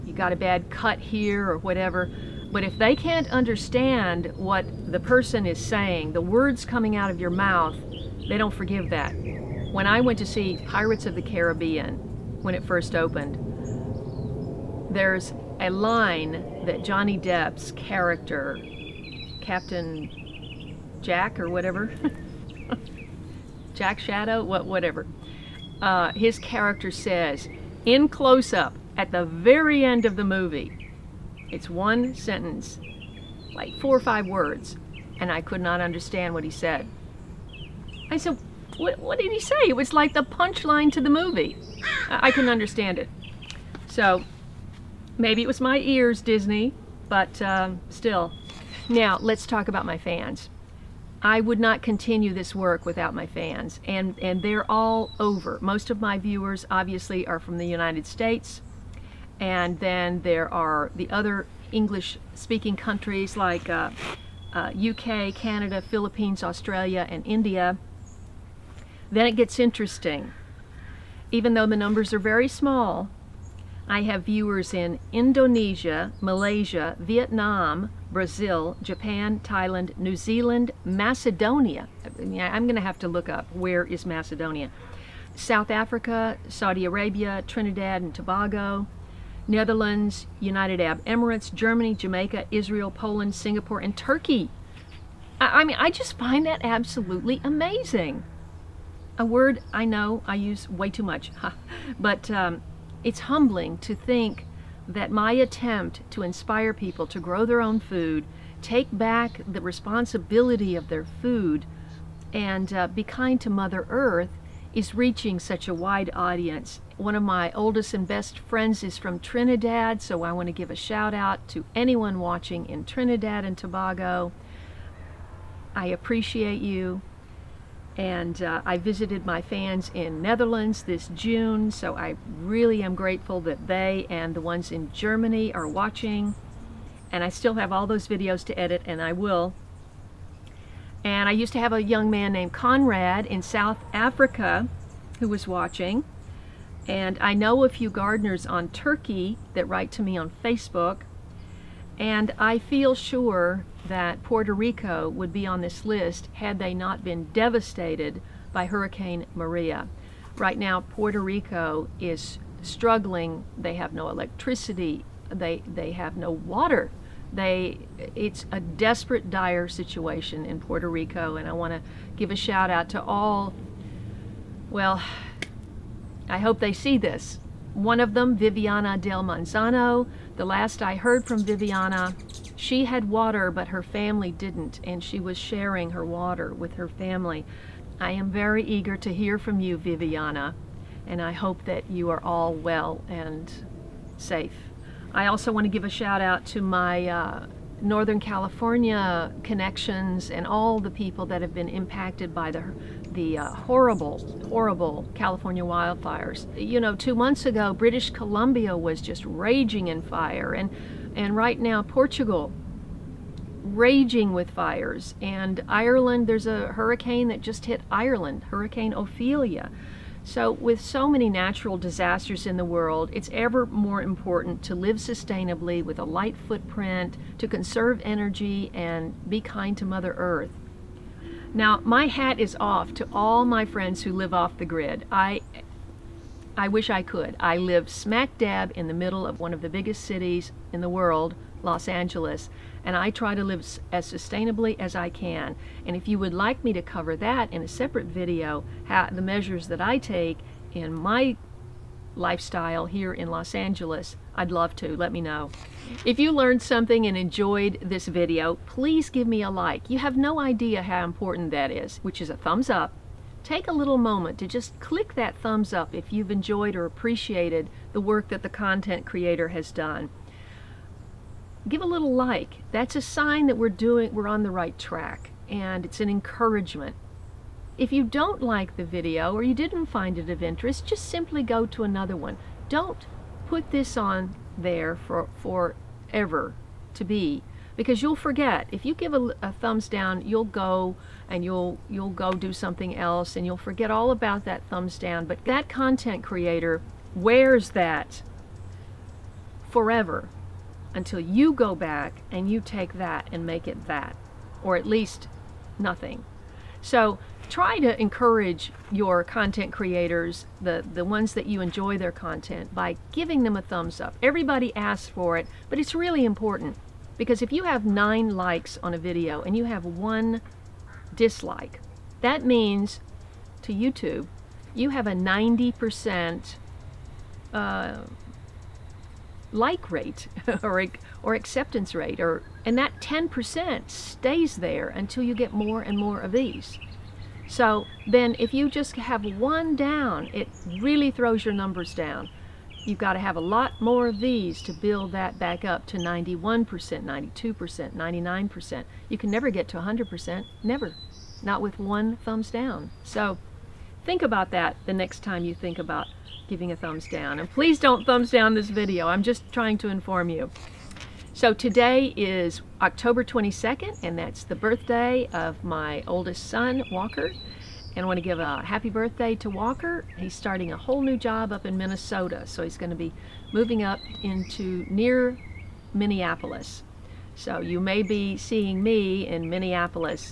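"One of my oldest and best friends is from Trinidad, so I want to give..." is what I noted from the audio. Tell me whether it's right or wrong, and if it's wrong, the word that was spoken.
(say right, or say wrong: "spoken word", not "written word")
right.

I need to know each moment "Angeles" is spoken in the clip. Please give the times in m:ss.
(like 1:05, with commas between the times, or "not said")
4:01, 4:13.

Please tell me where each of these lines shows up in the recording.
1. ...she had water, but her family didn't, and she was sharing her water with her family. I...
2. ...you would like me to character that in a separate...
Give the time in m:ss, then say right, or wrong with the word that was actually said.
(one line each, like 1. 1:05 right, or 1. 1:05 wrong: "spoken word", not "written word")
1. 3:02 right
2. 4:06 wrong: "cover", not "character".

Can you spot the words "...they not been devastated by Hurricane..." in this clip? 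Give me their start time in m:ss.
2:36.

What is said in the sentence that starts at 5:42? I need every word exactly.
You've got to have a lot more of these to build that back up to 91%, 92%, 99%.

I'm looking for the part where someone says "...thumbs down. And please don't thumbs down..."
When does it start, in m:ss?
5:56.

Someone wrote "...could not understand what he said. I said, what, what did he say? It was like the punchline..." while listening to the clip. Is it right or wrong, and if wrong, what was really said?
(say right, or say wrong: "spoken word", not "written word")
right.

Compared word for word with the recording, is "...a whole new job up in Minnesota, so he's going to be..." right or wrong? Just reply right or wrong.
right.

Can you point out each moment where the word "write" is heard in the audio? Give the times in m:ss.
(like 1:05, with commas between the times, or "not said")
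2:29.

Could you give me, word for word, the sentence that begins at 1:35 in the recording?
I, I mean, I just find that absolutely amazing.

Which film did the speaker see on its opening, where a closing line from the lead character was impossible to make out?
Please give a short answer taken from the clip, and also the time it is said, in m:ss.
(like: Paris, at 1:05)
Pirates of the Caribbean, at 0:10.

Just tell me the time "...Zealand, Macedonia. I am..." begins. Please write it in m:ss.
1:20.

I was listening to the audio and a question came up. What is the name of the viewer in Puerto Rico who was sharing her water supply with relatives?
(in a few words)
Viviana Del Manzano.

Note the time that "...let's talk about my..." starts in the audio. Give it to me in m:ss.
0:49.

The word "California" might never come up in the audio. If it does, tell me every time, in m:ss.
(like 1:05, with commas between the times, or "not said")
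3:18, 3:25.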